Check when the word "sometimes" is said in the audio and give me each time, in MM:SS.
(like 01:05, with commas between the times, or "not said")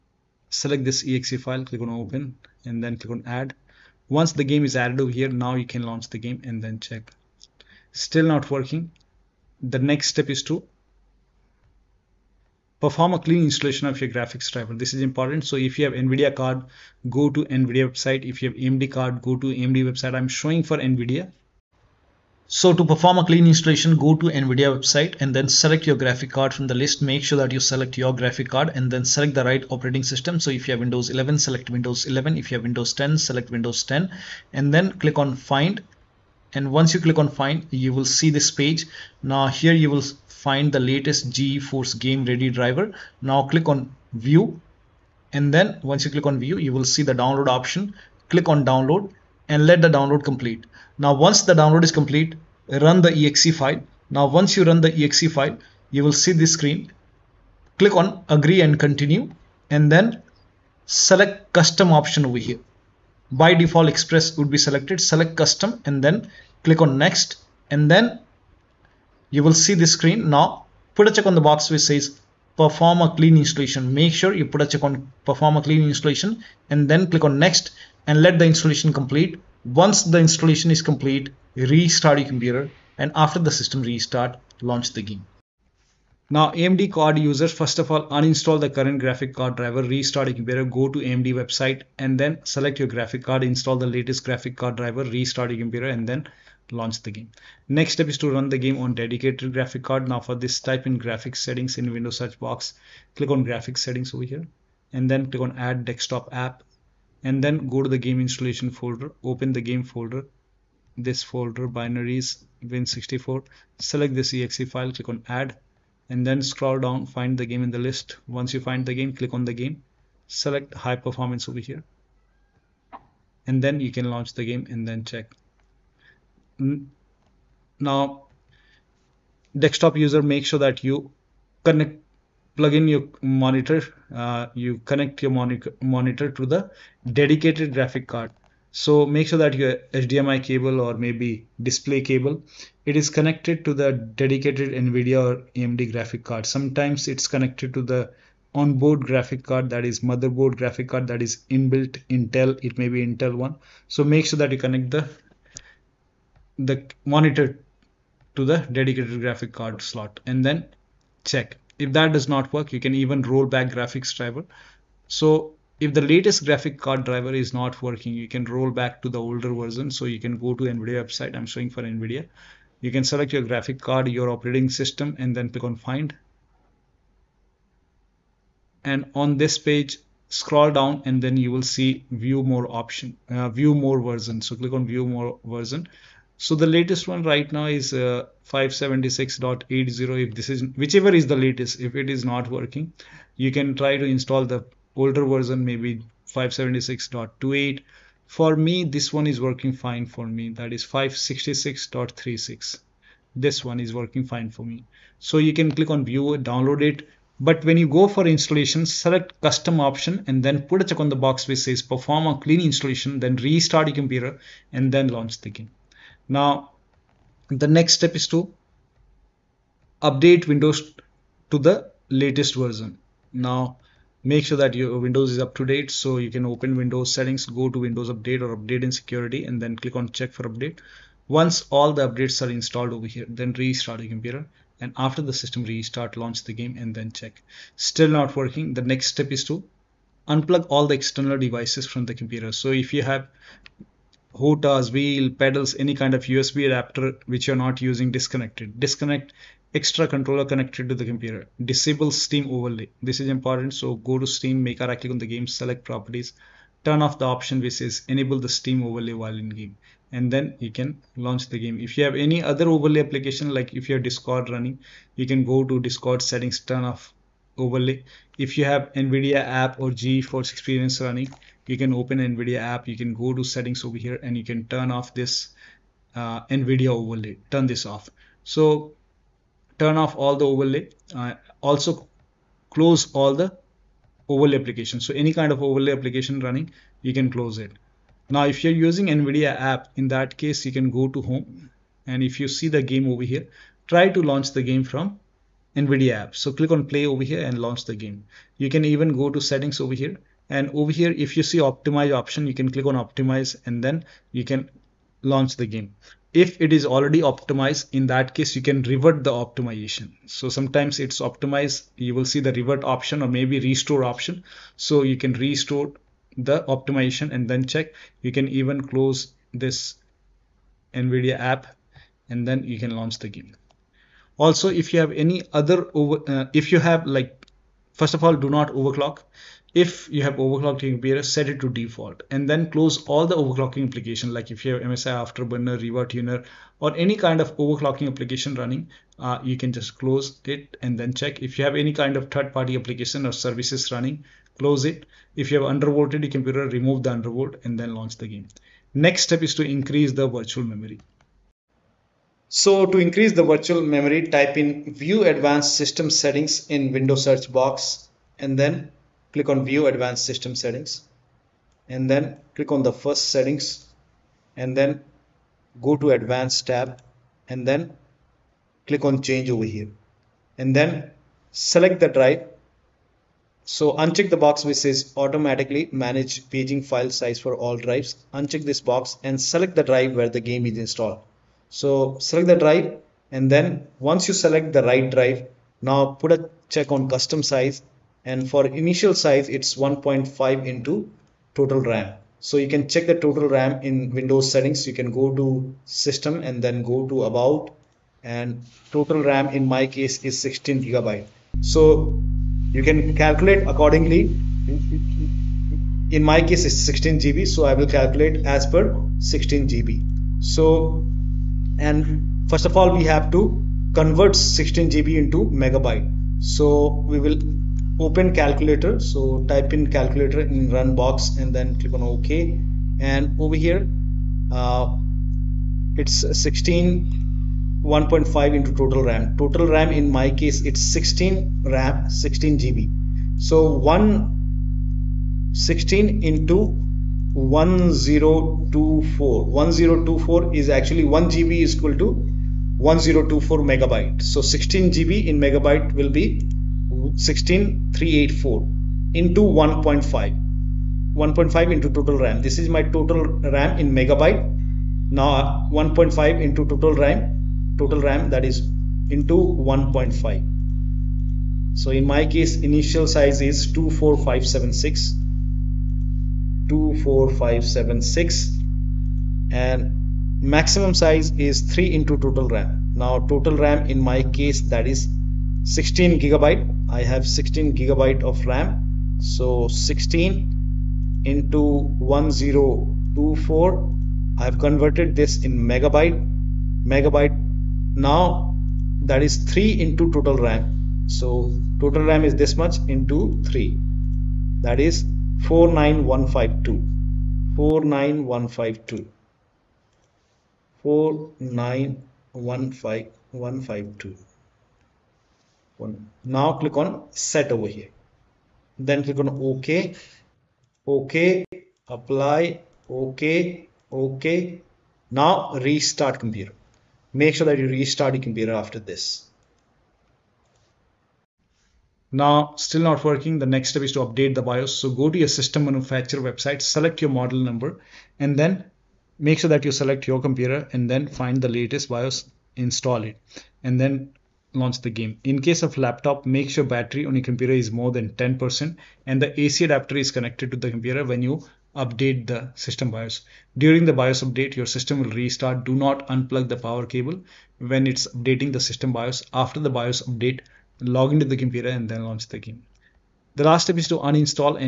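02:26, 05:10.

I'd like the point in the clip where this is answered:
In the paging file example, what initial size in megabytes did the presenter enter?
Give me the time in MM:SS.
07:43.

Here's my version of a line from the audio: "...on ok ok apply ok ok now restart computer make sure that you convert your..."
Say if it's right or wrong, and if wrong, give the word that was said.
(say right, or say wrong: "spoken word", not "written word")
wrong: "restart", not "convert".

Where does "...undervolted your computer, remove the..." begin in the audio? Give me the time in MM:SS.
05:45.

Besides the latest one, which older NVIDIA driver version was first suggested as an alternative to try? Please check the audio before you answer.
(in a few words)
576.28.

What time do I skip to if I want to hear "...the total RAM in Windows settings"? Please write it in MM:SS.
06:33.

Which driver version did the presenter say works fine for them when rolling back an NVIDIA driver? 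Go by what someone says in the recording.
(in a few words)
566.36.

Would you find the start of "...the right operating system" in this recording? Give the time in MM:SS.
00:29.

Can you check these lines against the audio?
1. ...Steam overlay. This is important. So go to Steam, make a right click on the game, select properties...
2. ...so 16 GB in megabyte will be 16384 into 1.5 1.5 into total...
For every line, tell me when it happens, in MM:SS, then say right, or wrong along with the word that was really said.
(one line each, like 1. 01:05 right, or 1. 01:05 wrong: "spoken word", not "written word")
1. 04:12 right
2. 07:24 right.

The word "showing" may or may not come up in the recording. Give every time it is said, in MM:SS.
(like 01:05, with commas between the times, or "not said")
00:20, 02:51.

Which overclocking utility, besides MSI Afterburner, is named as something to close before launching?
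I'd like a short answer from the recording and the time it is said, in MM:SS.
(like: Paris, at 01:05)
RivaTuner, at 05:35.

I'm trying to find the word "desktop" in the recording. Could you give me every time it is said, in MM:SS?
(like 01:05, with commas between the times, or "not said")
01:45, 02:09.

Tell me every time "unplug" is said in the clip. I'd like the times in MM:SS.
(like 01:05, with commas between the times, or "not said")
04:00, 09:06.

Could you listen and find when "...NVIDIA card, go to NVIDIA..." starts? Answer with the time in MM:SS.
00:15.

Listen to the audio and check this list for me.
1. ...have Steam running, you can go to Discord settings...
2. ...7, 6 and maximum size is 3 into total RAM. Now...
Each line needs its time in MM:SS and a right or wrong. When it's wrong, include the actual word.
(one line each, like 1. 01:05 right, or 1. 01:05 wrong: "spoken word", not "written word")
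1. 04:23 wrong: "Discord", not "Steam"
2. 07:47 right.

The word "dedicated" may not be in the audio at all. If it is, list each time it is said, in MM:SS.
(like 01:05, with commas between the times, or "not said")
01:38, 02:17, 02:23, 02:38.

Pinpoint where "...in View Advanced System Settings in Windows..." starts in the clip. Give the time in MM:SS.
05:54.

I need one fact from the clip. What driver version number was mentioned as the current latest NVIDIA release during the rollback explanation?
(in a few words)
576.80.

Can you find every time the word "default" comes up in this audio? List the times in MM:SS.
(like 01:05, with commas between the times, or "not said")
01:03, 05:31.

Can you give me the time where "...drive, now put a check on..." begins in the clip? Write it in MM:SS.
06:25.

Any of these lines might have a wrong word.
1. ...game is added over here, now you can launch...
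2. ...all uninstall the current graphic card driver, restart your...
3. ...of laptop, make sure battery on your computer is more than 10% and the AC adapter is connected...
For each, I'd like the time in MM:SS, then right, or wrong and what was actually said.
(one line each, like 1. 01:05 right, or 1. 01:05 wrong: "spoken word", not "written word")
1. 00:04 right
2. 01:27 right
3. 08:55 right.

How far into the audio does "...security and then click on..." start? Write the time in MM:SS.
03:48.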